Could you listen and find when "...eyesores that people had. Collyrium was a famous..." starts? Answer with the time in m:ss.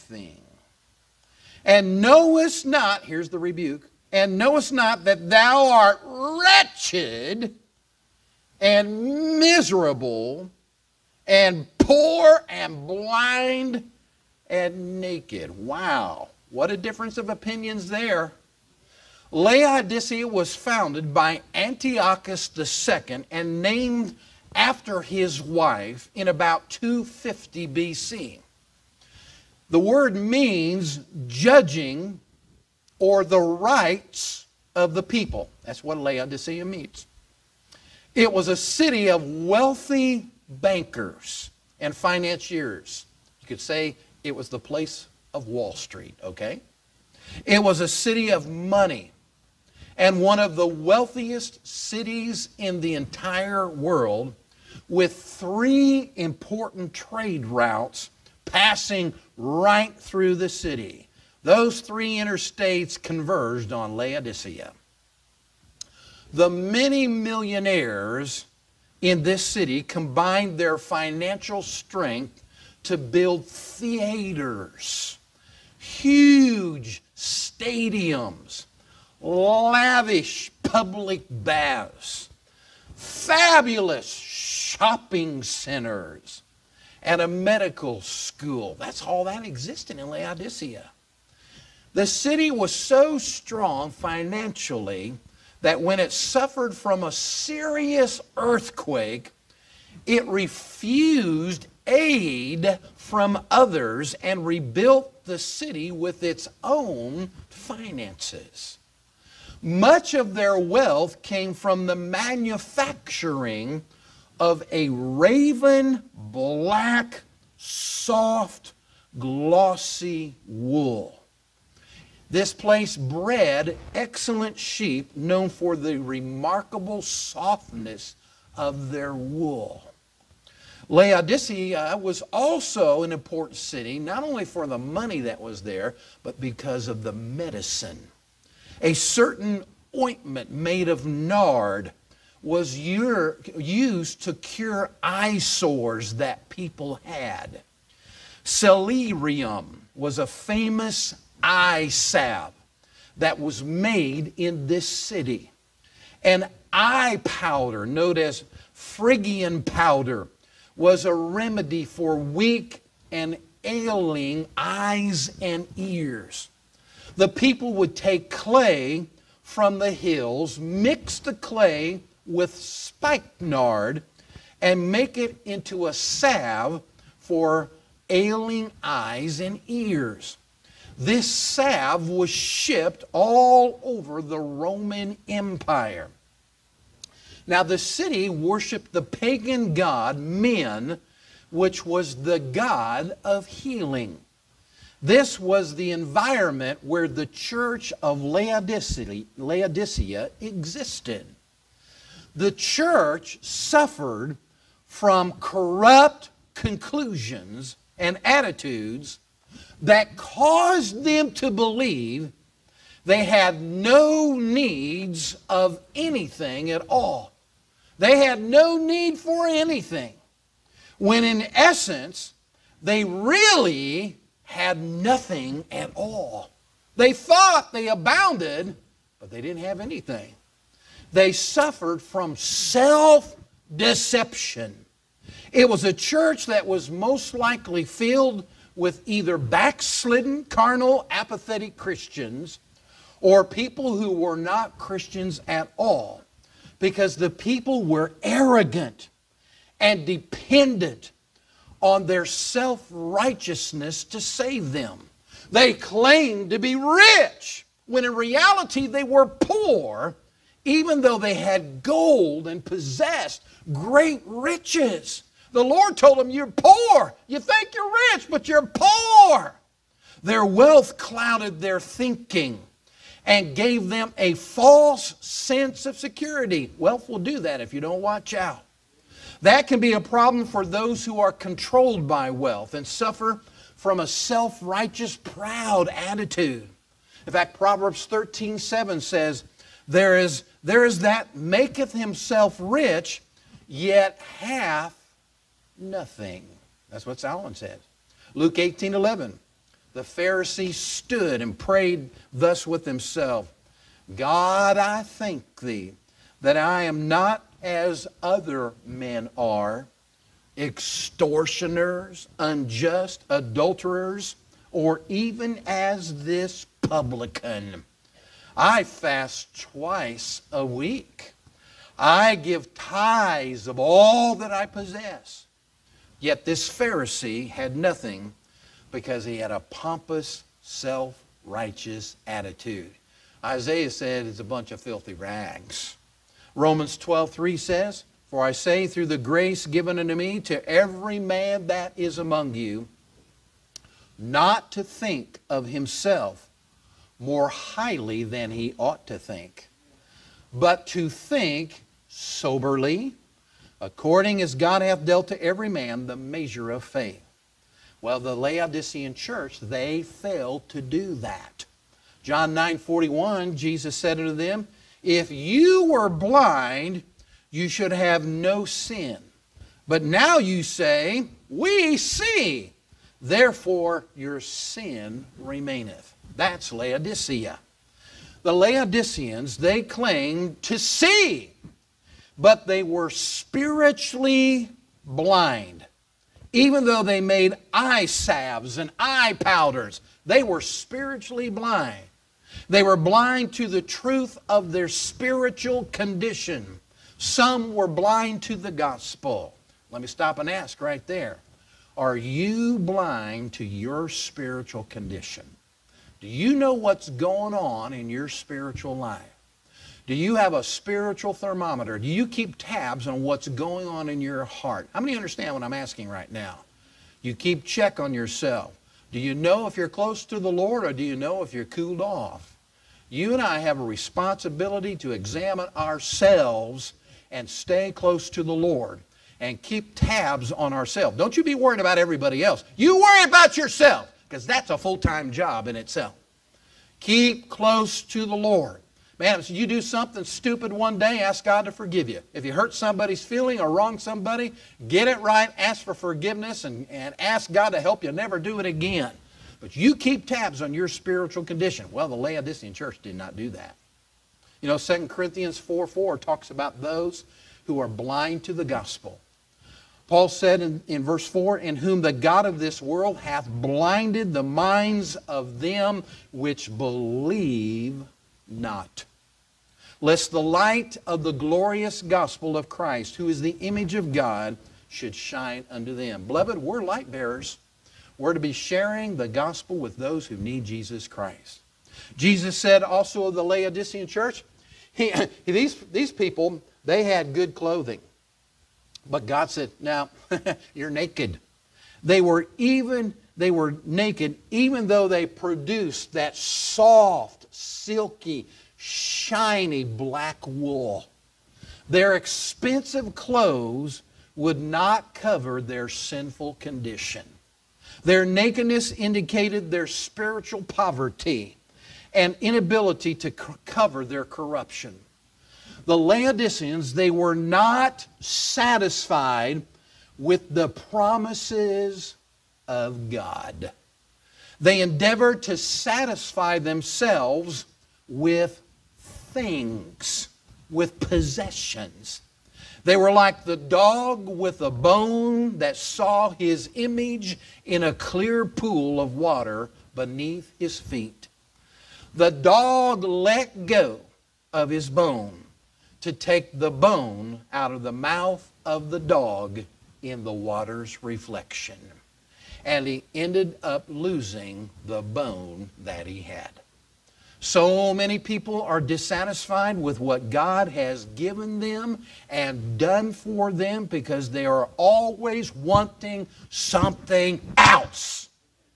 2:25.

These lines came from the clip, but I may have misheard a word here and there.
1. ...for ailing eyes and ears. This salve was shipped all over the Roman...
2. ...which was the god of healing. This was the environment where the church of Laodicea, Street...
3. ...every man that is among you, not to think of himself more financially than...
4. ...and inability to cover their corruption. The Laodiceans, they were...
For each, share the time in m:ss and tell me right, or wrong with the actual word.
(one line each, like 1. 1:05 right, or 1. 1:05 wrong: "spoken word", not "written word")
1. 2:57 right
2. 3:11 wrong: "Laodicea", not "Street"
3. 5:40 wrong: "highly", not "financially"
4. 8:32 right.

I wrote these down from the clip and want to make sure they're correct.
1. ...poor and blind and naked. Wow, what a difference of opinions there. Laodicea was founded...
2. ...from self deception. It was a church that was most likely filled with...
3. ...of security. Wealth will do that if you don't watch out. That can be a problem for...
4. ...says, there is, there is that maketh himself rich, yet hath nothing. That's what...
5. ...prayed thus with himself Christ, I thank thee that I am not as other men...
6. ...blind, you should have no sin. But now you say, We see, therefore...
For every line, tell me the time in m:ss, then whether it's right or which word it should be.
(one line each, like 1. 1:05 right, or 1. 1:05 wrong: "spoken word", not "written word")
1. 0:11 right
2. 3:52 right
3. 4:35 right
4. 4:49 right
5. 5:01 wrong: "God", not "Christ"
6. 6:06 right.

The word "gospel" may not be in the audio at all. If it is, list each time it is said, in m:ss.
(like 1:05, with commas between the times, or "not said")
6:38, 7:38, 7:52, 7:59.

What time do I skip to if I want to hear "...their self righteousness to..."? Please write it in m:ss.
4:12.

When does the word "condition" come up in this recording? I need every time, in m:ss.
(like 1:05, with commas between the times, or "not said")
6:35, 6:44, 7:31, 8:26.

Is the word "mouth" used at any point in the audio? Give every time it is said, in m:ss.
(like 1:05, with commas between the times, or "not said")
9:07.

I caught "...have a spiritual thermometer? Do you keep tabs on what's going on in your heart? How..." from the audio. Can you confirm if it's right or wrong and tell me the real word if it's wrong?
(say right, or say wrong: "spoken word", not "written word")
right.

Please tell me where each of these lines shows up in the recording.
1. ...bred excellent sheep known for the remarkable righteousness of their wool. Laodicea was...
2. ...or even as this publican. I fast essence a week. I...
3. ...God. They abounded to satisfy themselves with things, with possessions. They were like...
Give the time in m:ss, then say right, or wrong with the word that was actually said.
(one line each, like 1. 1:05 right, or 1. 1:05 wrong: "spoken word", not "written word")
1. 2:02 wrong: "softness", not "righteousness"
2. 5:14 wrong: "twice", not "essence"
3. 8:43 wrong: "endeavored", not "abounded".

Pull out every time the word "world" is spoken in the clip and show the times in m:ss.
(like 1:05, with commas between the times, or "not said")
0:53, 7:42.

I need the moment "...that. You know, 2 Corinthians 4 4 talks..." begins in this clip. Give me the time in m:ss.
7:33.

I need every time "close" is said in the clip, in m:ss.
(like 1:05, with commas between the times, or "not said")
6:59, 7:07, 7:17.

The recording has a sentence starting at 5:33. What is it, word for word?
Isaiah said it's a bunch of filthy rags.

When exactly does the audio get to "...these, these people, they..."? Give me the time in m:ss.
8:05.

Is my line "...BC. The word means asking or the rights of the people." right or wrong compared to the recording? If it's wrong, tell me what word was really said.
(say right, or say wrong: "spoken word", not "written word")
wrong: "judging", not "asking".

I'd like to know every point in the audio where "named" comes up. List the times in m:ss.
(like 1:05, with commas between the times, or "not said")
0:23.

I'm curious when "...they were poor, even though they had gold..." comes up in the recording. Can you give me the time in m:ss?
4:18.